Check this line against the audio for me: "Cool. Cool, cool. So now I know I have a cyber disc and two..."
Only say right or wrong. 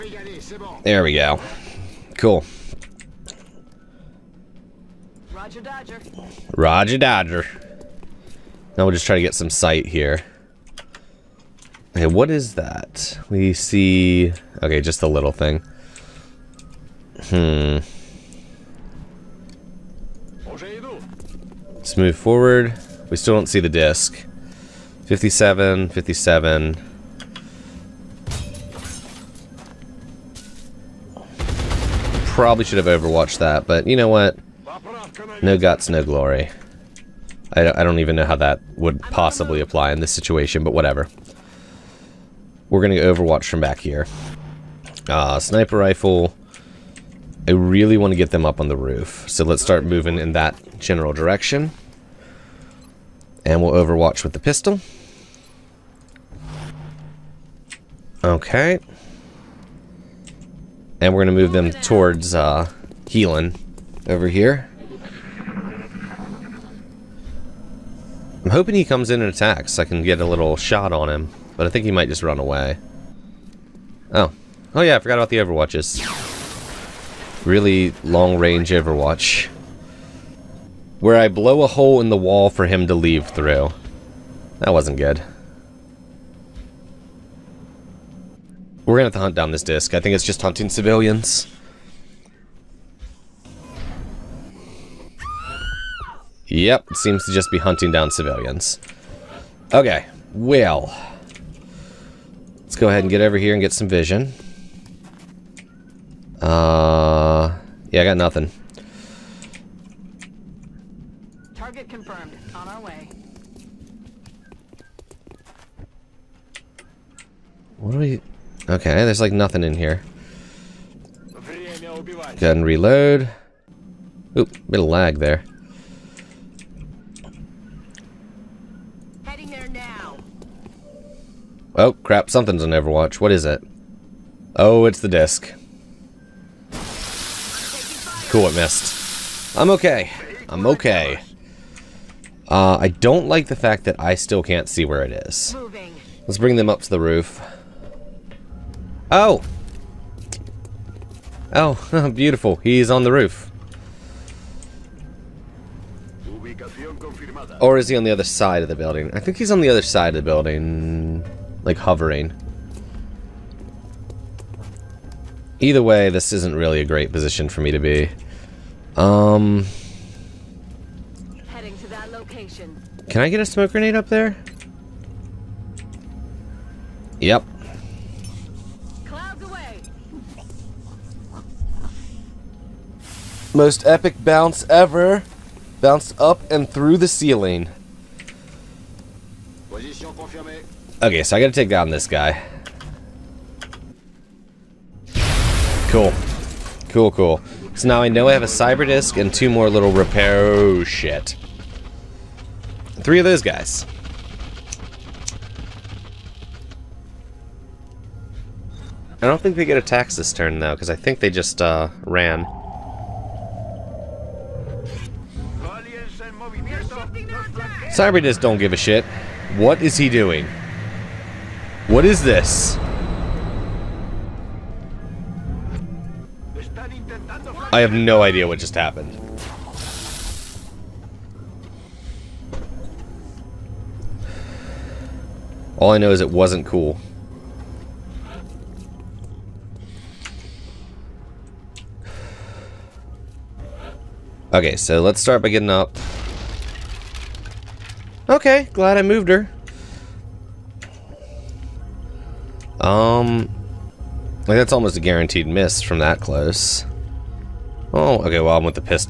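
right.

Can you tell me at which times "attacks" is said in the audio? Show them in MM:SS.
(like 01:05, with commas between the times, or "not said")
01:09, 03:29.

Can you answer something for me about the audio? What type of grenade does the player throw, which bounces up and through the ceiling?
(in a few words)
Smoke grenade.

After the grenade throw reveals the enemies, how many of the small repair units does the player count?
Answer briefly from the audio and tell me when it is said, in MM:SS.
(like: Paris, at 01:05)
3, at 03:23.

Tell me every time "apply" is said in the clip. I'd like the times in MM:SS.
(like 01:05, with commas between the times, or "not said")
00:39.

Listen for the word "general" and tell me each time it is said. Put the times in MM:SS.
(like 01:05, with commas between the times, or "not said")
00:50.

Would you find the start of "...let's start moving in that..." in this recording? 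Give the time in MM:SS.
00:49.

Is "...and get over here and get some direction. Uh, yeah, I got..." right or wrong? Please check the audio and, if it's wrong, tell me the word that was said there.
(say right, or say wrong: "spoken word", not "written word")
wrong: "vision", not "direction".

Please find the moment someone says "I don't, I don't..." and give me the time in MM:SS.
00:37.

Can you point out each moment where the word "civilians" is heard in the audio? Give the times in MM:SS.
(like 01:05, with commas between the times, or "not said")
01:30, 01:38.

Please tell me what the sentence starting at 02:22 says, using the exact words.
Uh, I don't like the fact that I still can't see where it is.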